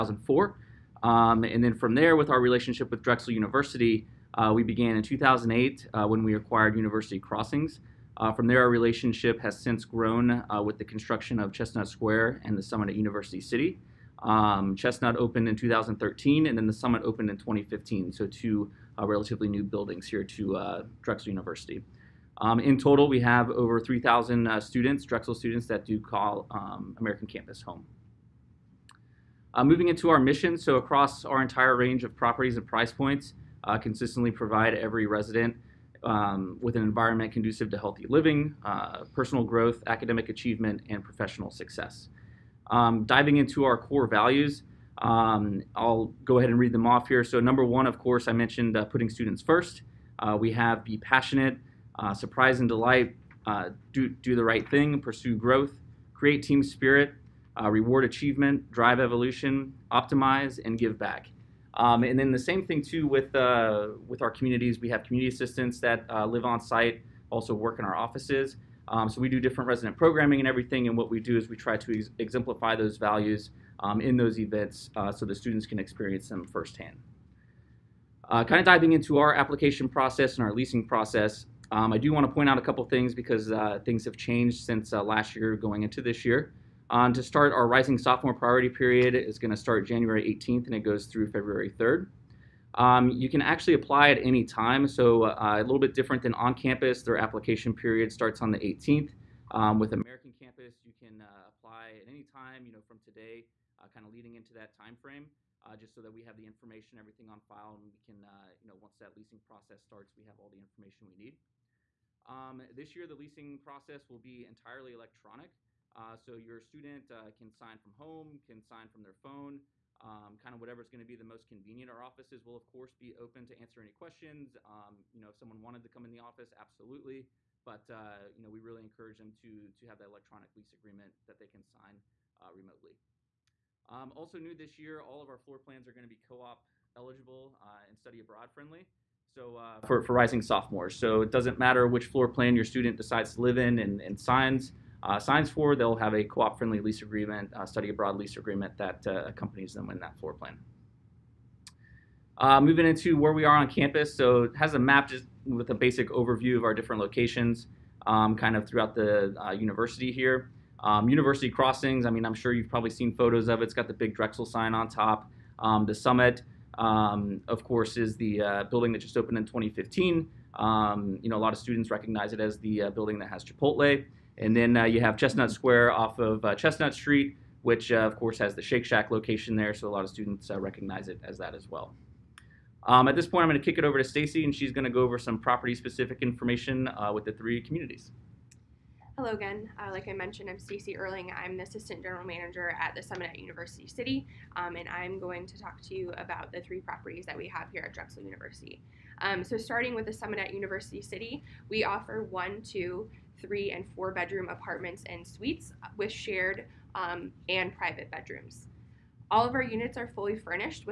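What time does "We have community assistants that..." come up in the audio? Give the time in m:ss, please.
1:04.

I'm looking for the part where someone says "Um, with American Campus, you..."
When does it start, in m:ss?
1:39.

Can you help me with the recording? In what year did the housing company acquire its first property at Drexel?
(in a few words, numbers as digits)
2008.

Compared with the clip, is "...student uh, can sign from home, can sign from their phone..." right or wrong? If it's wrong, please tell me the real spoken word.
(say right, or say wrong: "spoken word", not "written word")
right.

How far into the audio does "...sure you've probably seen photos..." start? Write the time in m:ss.
2:42.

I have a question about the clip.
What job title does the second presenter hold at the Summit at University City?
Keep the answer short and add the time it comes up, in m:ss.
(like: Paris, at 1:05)
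Assistant General Manager, at 3:11.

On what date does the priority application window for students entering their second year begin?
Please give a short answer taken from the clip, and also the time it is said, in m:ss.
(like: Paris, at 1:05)
January 18th, at 1:29.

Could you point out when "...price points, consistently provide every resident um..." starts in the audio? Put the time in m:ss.
0:32.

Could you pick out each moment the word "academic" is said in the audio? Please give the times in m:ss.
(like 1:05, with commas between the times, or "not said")
0:39.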